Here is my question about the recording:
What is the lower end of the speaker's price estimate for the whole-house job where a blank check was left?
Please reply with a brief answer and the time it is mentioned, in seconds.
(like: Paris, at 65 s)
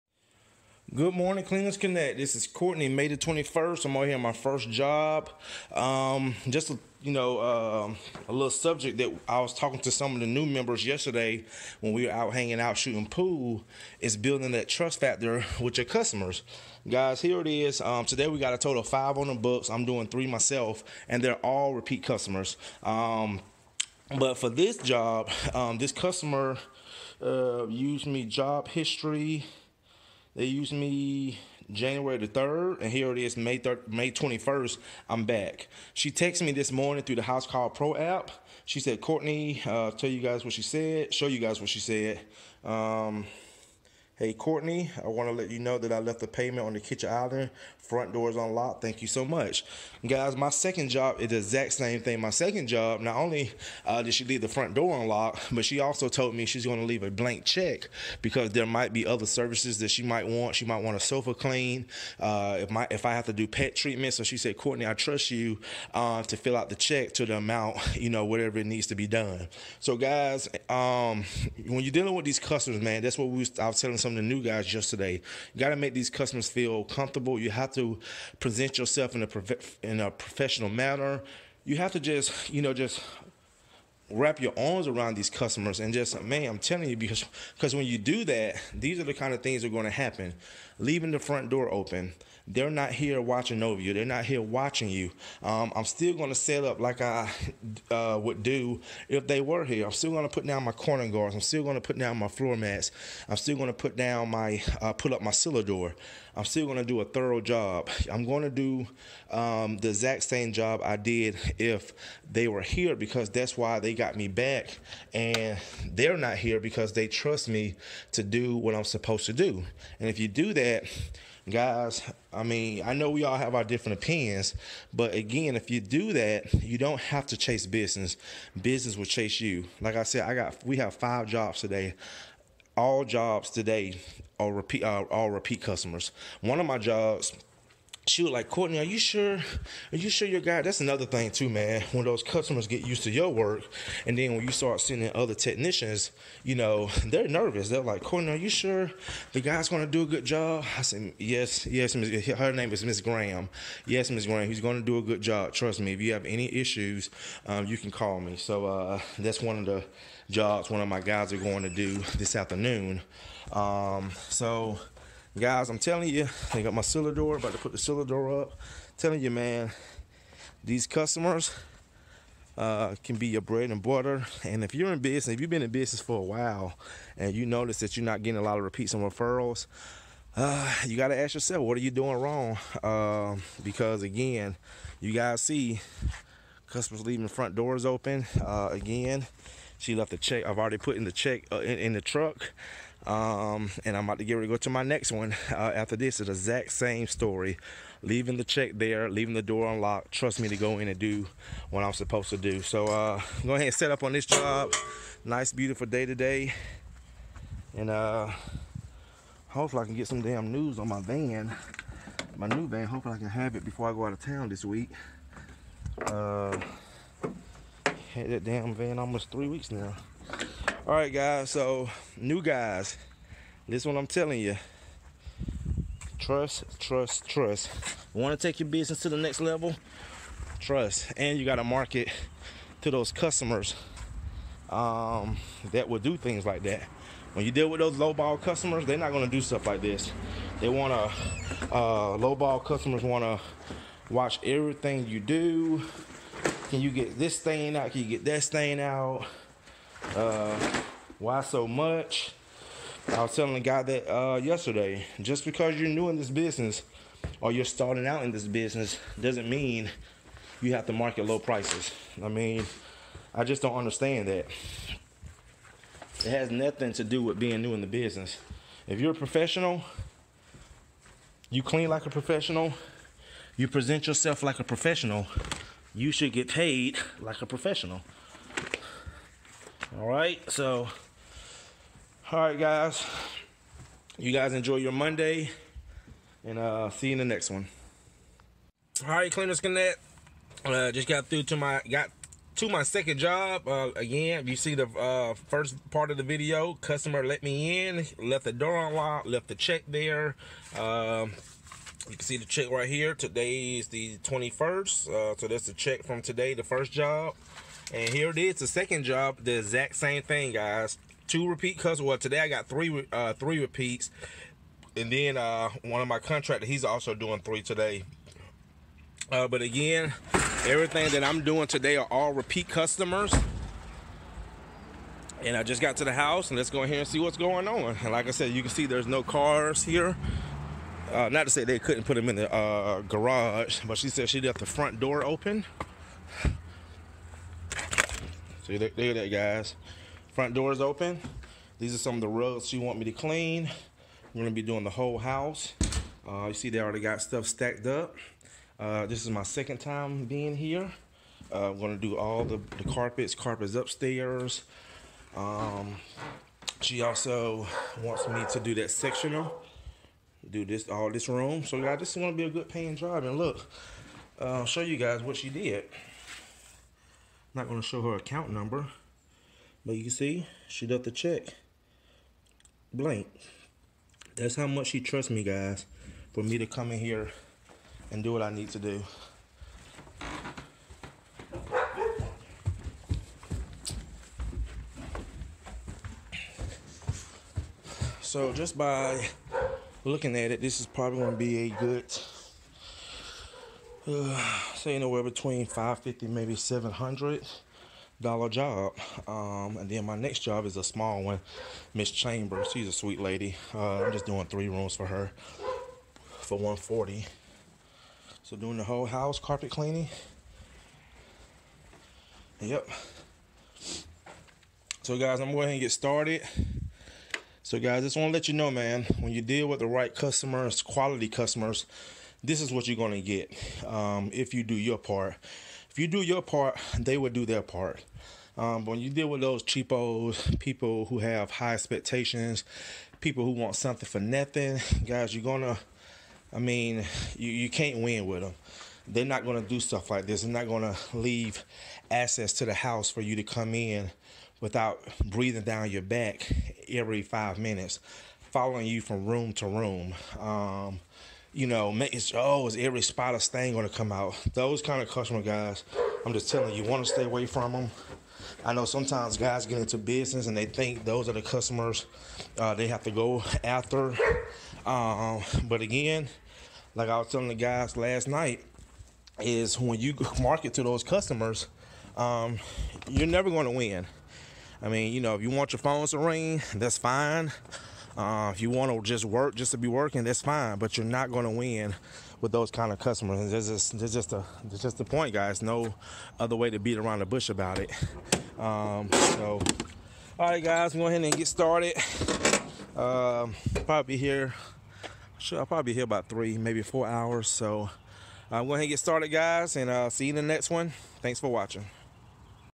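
$550, at 395 s.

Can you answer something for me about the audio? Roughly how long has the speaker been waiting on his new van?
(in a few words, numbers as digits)
almost 3 weeks.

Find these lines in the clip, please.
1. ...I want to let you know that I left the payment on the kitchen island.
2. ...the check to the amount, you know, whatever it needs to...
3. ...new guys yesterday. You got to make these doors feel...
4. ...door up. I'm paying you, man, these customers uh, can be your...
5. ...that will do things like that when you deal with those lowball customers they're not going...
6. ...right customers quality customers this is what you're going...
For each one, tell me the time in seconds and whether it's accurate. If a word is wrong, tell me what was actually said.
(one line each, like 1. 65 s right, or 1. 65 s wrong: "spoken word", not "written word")
1. 45 s right
2. 66 s right
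3. 74 s wrong: "customers", not "doors"
4. 168 s wrong: "telling", not "paying"
5. 235 s right
6. 419 s right.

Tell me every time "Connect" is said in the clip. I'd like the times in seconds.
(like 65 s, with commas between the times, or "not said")
1 s, 289 s.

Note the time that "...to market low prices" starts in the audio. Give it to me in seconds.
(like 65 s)
260 s.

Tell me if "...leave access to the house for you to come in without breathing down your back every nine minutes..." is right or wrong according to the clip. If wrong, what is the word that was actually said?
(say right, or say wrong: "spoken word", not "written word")
wrong: "five", not "nine".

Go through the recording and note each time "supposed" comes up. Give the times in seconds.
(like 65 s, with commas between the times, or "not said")
118 s, 201 s.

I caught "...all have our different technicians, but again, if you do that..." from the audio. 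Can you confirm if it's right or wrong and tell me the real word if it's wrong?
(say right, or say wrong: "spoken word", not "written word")
wrong: "opinions", not "technicians".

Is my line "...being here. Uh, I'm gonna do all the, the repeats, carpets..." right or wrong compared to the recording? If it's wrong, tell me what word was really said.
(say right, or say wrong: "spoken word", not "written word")
wrong: "carpets", not "repeats".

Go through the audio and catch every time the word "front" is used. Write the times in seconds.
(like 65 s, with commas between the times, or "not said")
47 s, 54 s, 91 s, 187 s, 334 s, 340 s.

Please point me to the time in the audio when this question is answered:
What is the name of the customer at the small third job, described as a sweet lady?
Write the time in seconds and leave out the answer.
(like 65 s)
402 s.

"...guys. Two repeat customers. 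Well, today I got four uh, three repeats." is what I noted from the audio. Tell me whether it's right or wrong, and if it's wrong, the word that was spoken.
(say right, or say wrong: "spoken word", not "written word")
wrong: "three", not "four".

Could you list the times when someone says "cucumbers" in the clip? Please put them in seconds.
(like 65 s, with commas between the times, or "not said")
not said.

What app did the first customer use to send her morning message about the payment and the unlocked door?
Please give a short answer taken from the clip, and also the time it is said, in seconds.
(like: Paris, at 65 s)
Housecall Pro, at 37 s.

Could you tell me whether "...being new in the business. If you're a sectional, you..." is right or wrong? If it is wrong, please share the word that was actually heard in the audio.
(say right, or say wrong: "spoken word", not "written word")
wrong: "professional", not "sectional".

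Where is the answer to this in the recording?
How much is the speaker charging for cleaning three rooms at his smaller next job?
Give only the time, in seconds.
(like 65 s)
406 s.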